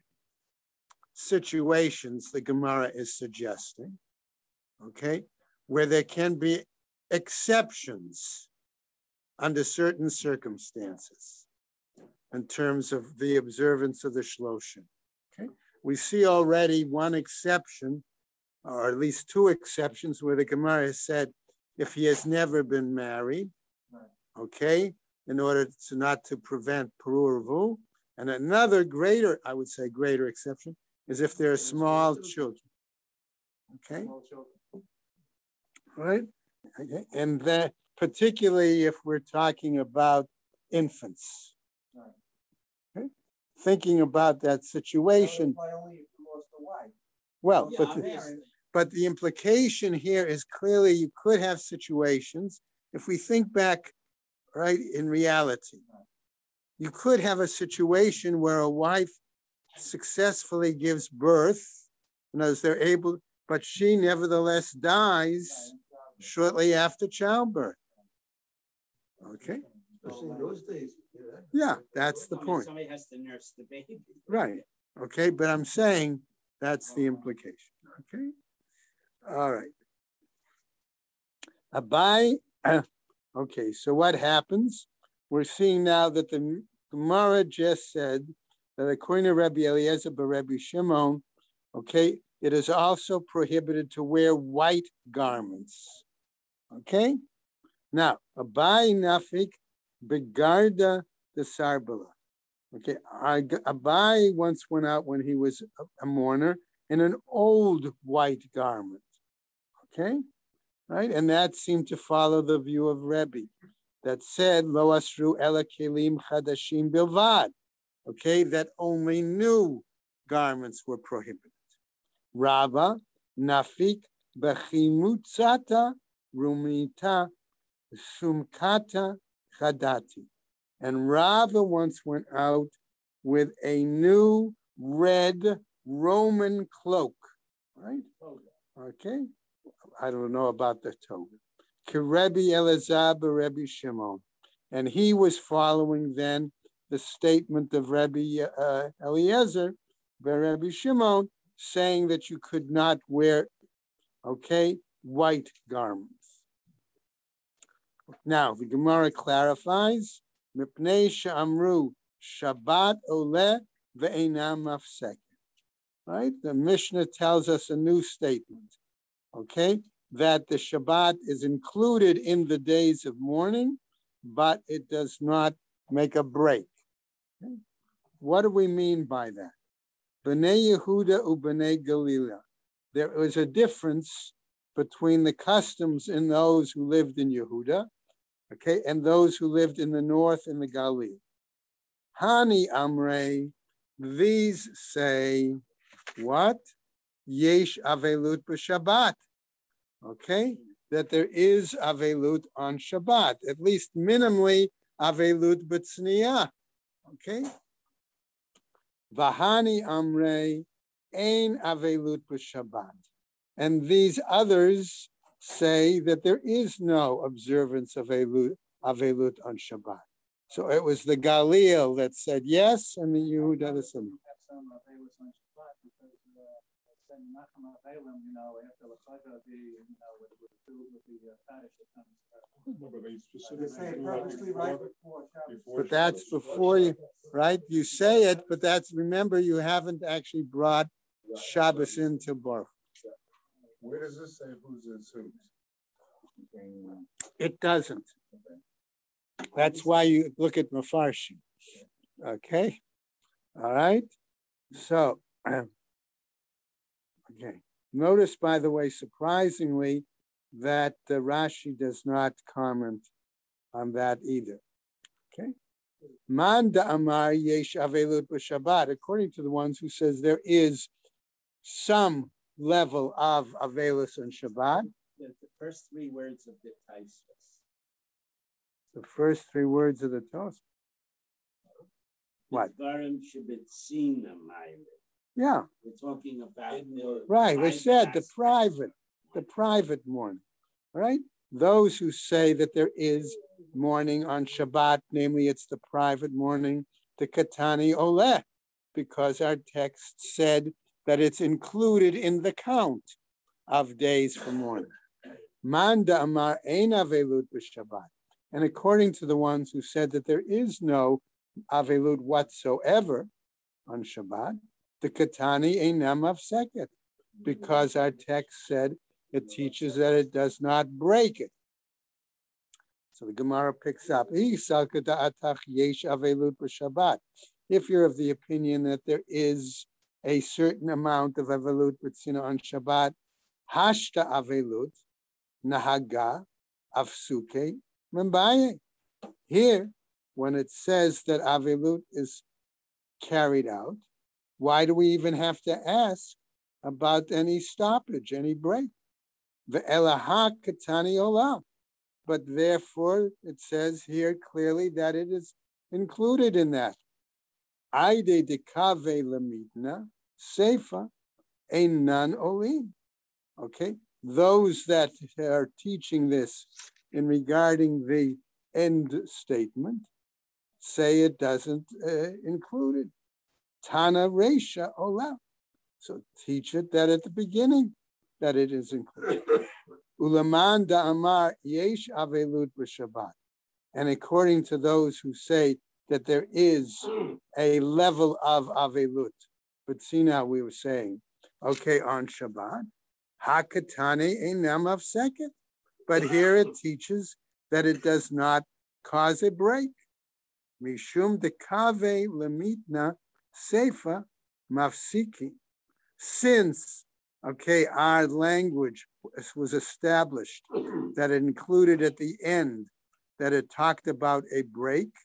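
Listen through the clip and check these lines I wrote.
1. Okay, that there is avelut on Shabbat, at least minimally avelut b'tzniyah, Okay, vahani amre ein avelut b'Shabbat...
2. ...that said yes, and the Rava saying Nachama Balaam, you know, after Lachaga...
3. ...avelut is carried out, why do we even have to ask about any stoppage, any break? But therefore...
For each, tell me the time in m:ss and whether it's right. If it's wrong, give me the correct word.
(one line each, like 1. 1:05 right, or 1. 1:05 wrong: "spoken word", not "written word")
1. 3:20 right
2. 3:41 wrong: "Yehuda", not "Rava"
3. 5:41 right.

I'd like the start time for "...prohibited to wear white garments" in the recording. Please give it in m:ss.
1:33.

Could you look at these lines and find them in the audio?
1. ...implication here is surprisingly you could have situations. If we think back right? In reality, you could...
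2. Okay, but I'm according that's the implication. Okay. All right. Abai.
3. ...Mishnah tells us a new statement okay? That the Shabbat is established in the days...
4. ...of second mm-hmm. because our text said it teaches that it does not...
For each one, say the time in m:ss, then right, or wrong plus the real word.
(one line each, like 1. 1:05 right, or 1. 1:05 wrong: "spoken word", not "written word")
1. 0:49 wrong: "clearly", not "surprisingly"
2. 1:15 wrong: "saying", not "according"
3. 2:46 wrong: "included", not "established"
4. 5:16 right.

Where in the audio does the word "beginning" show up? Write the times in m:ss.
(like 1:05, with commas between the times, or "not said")
6:17.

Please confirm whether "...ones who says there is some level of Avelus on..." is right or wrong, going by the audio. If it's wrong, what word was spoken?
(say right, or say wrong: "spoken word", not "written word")
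right.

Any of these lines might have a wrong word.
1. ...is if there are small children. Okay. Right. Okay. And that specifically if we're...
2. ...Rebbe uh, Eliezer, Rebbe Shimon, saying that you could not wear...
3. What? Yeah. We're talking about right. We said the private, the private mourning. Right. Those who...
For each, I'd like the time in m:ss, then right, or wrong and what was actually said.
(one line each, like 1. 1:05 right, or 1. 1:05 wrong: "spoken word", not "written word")
1. 0:31 wrong: "particularly", not "specifically"
2. 2:27 right
3. 4:42 right.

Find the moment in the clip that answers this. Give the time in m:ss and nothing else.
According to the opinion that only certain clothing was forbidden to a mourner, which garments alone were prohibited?
1:55.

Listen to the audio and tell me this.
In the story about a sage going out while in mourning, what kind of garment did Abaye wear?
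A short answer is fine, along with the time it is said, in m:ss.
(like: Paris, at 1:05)
Old white garment, at 1:47.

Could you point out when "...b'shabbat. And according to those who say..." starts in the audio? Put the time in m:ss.
6:22.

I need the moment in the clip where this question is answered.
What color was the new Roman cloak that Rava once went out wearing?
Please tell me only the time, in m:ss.
2:14.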